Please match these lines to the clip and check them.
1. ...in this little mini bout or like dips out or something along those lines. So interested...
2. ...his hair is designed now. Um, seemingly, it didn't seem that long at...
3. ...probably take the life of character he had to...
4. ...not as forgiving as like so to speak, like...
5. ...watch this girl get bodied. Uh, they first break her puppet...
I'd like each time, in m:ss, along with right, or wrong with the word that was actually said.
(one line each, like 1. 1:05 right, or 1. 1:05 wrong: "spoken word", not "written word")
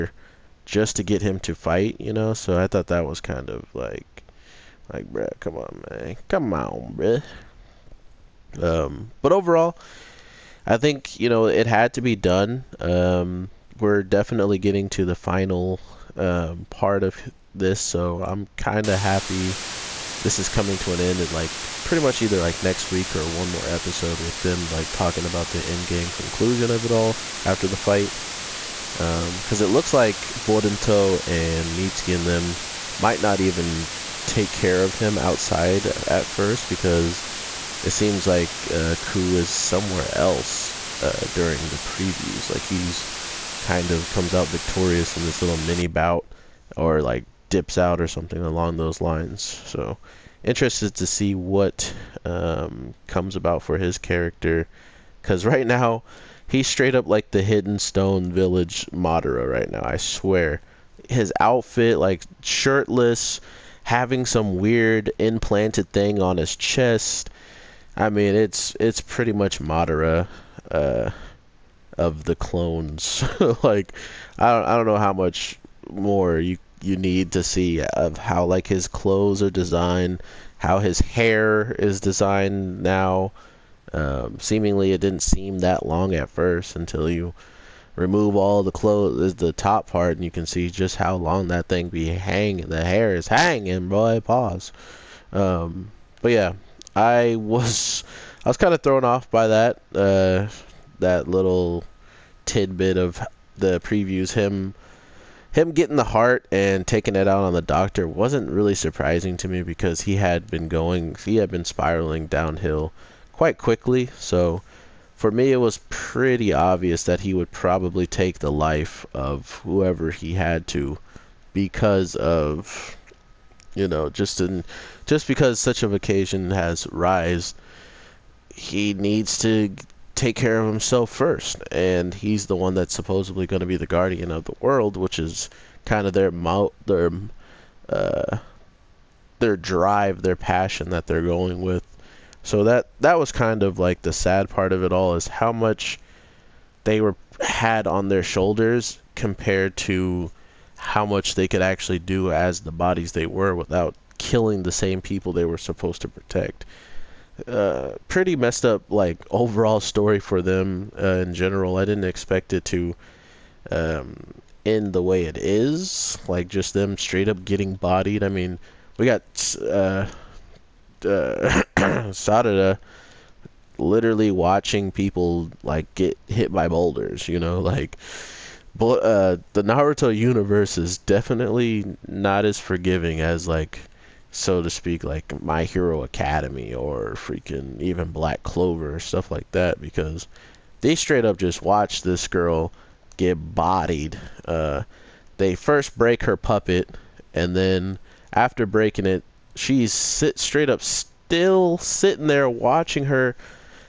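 1. 0:45 right
2. 1:20 right
3. 1:57 wrong: "whoever", not "character"
4. 3:02 right
5. 3:11 right.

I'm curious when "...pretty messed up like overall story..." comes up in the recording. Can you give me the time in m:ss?
2:38.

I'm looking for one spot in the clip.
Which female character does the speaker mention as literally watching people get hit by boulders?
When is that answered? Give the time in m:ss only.
2:51.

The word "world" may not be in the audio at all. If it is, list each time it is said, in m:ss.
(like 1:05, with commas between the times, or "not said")
2:14.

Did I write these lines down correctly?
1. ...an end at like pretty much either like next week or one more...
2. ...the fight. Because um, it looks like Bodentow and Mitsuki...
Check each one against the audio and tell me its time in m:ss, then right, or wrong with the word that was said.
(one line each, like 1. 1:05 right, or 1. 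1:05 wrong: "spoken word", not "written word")
1. 0:20 right
2. 0:27 right.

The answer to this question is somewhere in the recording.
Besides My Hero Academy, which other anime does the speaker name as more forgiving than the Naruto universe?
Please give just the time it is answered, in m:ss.
3:08.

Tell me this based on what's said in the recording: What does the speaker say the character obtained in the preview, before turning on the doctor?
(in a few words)
The heart.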